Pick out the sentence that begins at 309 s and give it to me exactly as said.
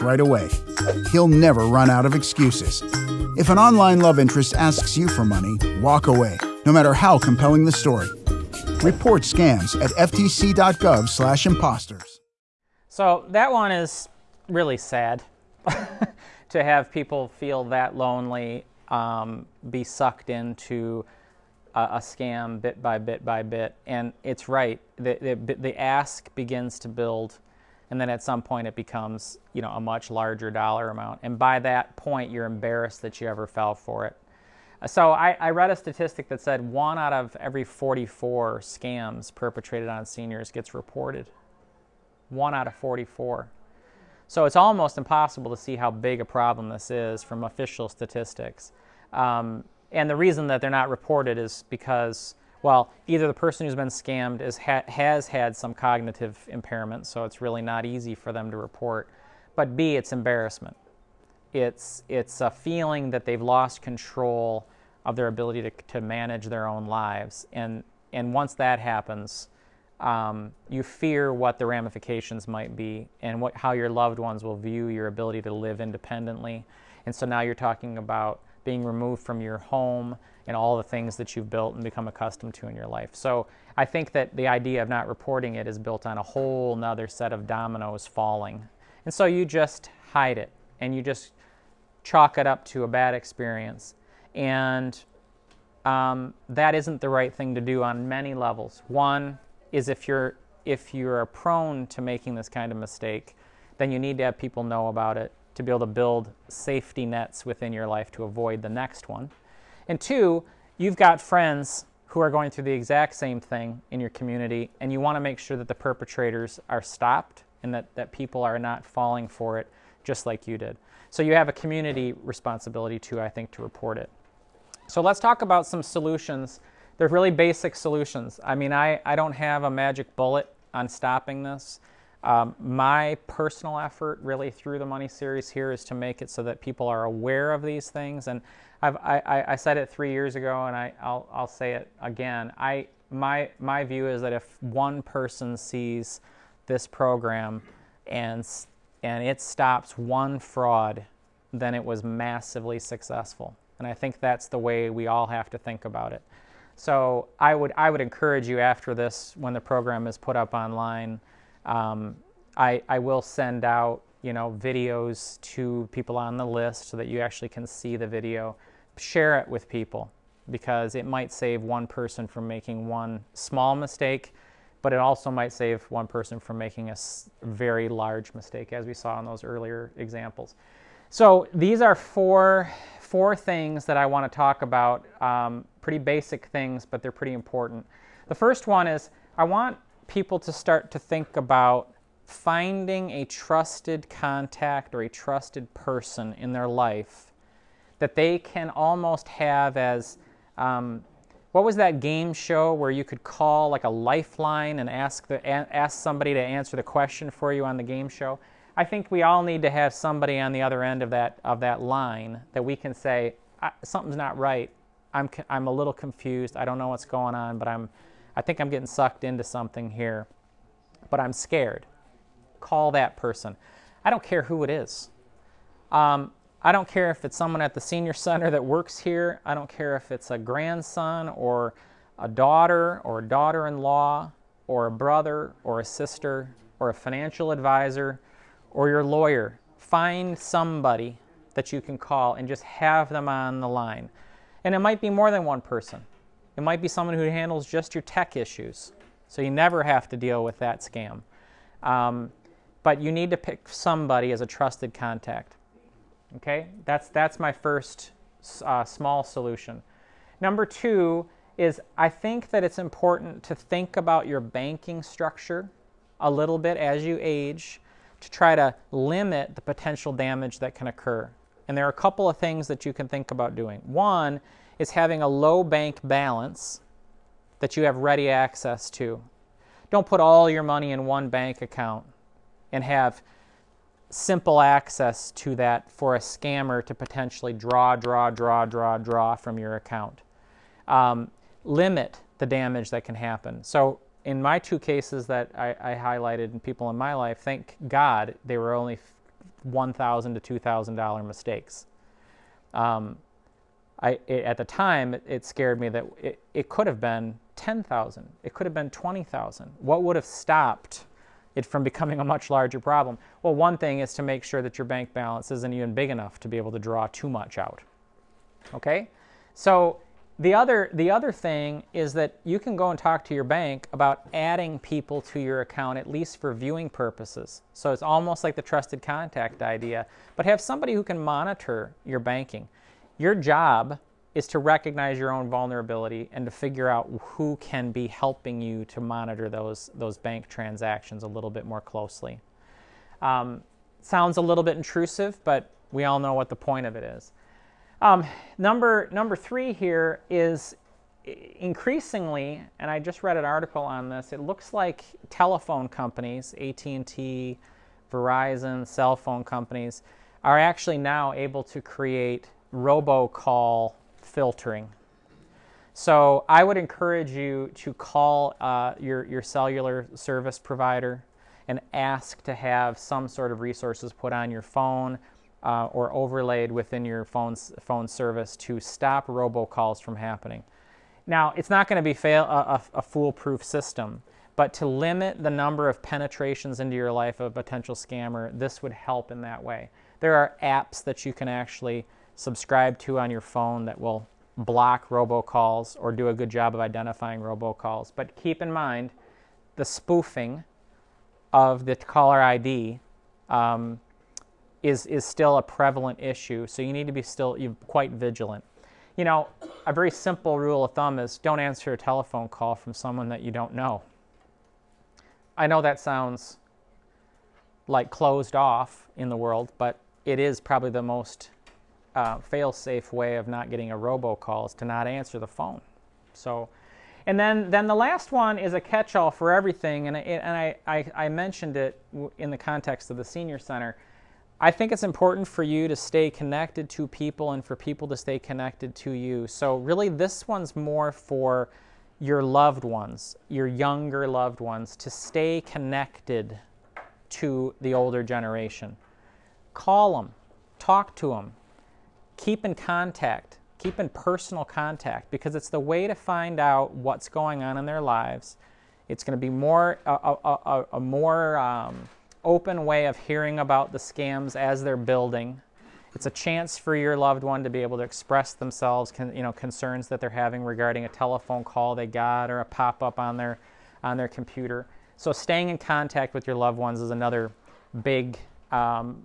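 What would have stopped it from becoming a much larger problem?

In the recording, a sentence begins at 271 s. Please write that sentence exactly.
And there are a couple of things that you can think about doing.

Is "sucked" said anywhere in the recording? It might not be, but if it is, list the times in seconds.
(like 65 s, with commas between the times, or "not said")
19 s, 218 s.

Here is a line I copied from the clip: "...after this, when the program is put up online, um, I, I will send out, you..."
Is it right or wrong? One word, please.
right.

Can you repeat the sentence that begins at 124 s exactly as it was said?
So let's talk about some solutions.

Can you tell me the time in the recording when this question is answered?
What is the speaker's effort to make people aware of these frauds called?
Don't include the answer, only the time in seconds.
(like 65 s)
134 s.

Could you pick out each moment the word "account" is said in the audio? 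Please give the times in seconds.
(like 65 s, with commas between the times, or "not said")
281 s, 289 s, 325 s.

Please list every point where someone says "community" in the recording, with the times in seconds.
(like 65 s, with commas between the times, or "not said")
114 s, 121 s.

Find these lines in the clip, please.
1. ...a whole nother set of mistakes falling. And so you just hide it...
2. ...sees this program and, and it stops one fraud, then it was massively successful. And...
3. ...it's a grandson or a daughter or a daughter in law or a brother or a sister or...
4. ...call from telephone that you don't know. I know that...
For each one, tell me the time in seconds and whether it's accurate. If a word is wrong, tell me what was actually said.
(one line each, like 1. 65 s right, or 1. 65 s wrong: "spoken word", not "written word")
1. 86 s wrong: "dominoes", not "mistakes"
2. 145 s right
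3. 230 s right
4. 412 s wrong: "someone", not "telephone".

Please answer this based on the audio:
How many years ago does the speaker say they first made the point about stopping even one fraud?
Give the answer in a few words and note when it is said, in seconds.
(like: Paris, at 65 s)
3 years ago, at 139 s.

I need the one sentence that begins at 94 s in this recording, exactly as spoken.
And um, that isn't the right thing to do on many levels.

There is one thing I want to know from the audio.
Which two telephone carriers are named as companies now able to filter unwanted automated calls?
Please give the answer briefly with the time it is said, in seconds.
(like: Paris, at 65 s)
AT&T, Verizon, at 356 s.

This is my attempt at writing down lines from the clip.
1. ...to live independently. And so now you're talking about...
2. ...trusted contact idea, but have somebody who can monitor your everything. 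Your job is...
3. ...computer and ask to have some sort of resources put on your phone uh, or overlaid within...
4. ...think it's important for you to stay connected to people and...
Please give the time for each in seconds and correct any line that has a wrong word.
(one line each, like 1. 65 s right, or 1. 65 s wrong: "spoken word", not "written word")
1. 75 s right
2. 328 s wrong: "banking", not "everything"
3. 370 s wrong: "provider", not "computer"
4. 434 s right.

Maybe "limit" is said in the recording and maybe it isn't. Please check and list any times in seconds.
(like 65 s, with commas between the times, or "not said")
268 s, 291 s, 384 s.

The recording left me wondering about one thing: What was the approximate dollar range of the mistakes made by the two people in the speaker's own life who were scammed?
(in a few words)
$1,000 to $2,000.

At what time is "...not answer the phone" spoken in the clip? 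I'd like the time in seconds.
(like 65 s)
424 s.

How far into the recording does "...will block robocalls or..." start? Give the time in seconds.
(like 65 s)
393 s.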